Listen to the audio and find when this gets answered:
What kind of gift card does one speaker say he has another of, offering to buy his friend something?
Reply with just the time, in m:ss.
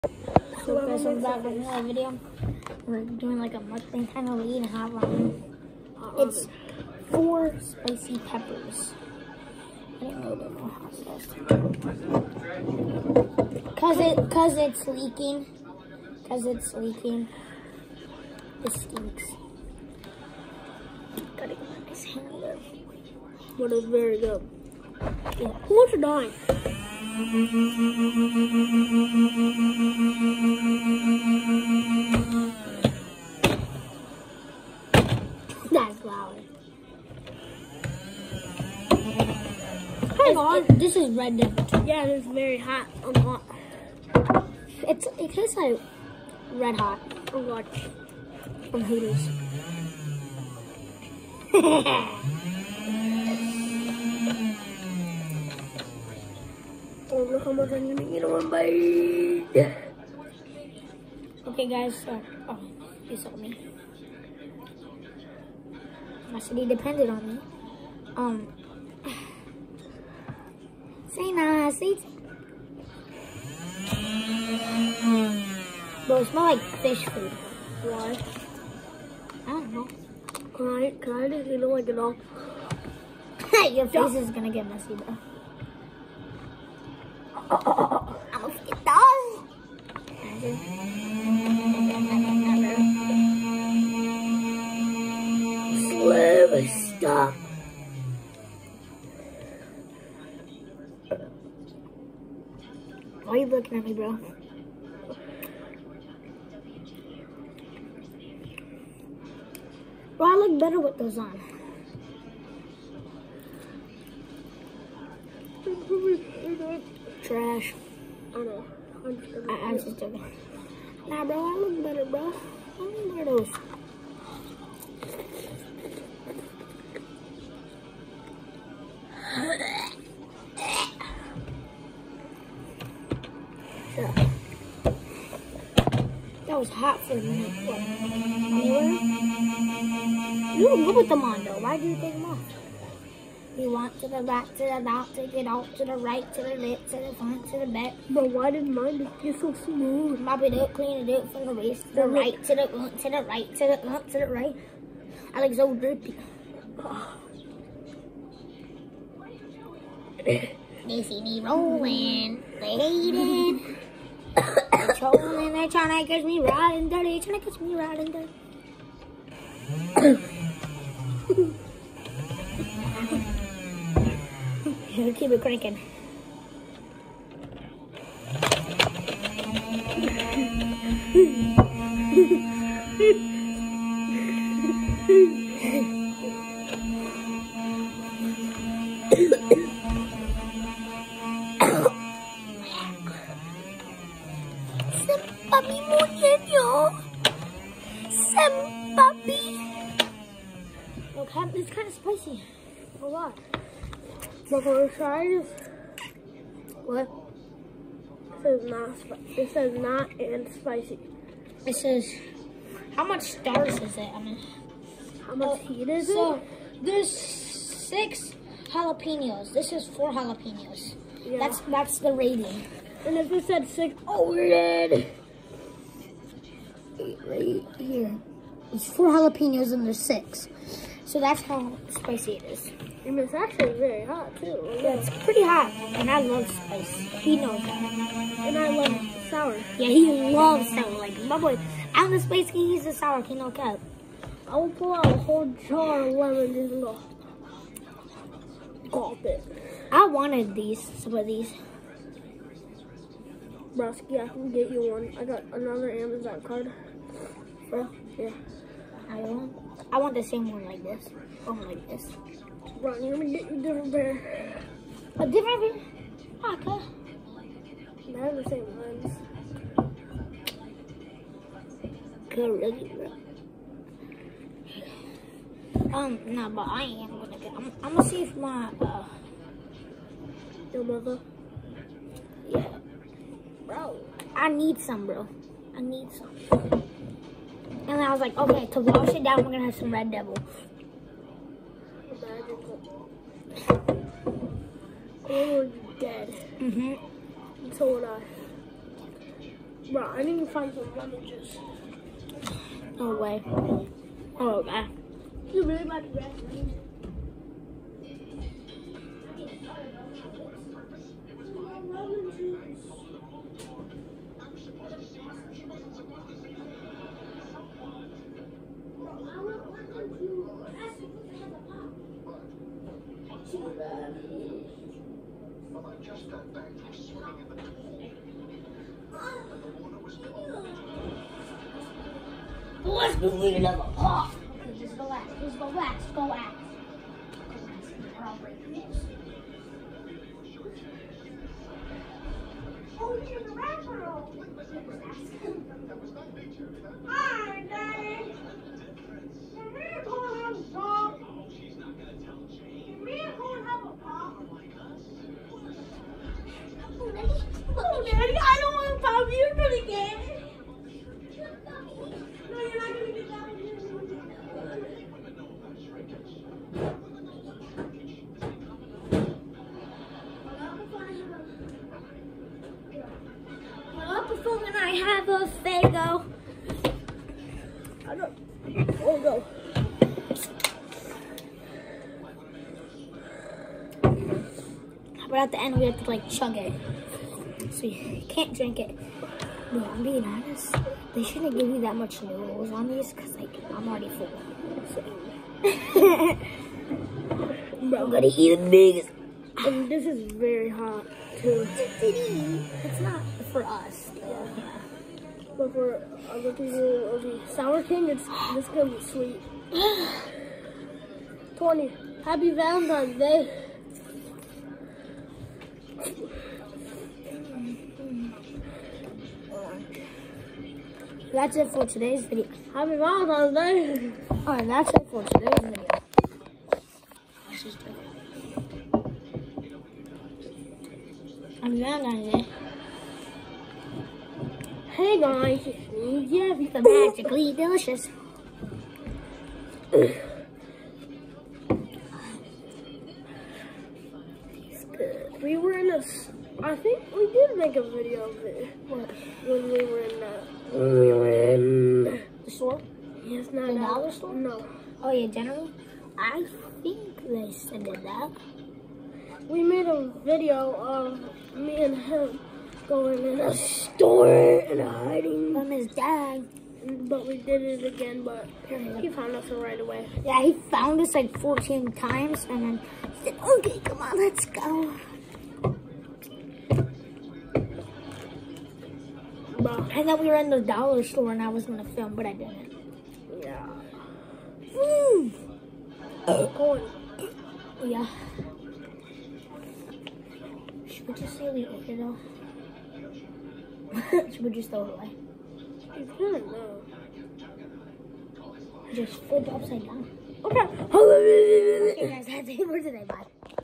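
4:15.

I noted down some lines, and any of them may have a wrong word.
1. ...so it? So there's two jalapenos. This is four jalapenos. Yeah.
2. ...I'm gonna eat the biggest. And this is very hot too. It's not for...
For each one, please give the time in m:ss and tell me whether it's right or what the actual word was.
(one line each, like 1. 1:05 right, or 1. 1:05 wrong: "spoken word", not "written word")
1. 3:36 wrong: "six", not "two"
2. 6:37 right.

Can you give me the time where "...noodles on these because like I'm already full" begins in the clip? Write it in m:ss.
6:32.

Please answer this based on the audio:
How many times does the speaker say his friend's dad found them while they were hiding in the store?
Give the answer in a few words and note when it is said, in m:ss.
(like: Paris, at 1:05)
14, at 7:51.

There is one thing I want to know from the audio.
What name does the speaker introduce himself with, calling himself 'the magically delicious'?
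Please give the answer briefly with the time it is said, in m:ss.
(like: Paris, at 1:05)
Jeffy, at 7:16.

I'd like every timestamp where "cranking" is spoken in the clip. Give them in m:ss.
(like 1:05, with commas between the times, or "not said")
2:55.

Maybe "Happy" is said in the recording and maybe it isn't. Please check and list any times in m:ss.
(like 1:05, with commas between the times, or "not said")
6:52, 7:02, 7:11.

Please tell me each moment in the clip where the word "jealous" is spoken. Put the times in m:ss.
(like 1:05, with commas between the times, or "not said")
not said.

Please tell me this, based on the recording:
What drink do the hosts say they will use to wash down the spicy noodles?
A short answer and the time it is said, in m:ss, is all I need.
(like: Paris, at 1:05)
Red Devil, at 4:49.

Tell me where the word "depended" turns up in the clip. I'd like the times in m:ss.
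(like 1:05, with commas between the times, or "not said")
1:06.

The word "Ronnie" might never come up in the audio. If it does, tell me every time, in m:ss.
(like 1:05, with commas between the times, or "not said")
4:22.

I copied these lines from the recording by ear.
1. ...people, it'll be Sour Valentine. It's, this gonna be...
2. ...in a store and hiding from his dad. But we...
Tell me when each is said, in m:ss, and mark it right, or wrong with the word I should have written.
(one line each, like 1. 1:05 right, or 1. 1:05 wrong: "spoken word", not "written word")
1. 6:46 wrong: "King", not "Valentine"
2. 7:43 right.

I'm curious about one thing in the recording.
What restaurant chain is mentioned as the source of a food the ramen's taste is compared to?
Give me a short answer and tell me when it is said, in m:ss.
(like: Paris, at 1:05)
Hooters, at 0:48.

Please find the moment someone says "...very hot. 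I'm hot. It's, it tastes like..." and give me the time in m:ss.
0:42.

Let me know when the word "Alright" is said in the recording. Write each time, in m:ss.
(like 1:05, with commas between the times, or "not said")
7:04.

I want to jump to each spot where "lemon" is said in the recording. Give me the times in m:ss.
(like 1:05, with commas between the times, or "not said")
4:06, 5:00.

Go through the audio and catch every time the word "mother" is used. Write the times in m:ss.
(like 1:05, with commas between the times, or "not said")
4:40.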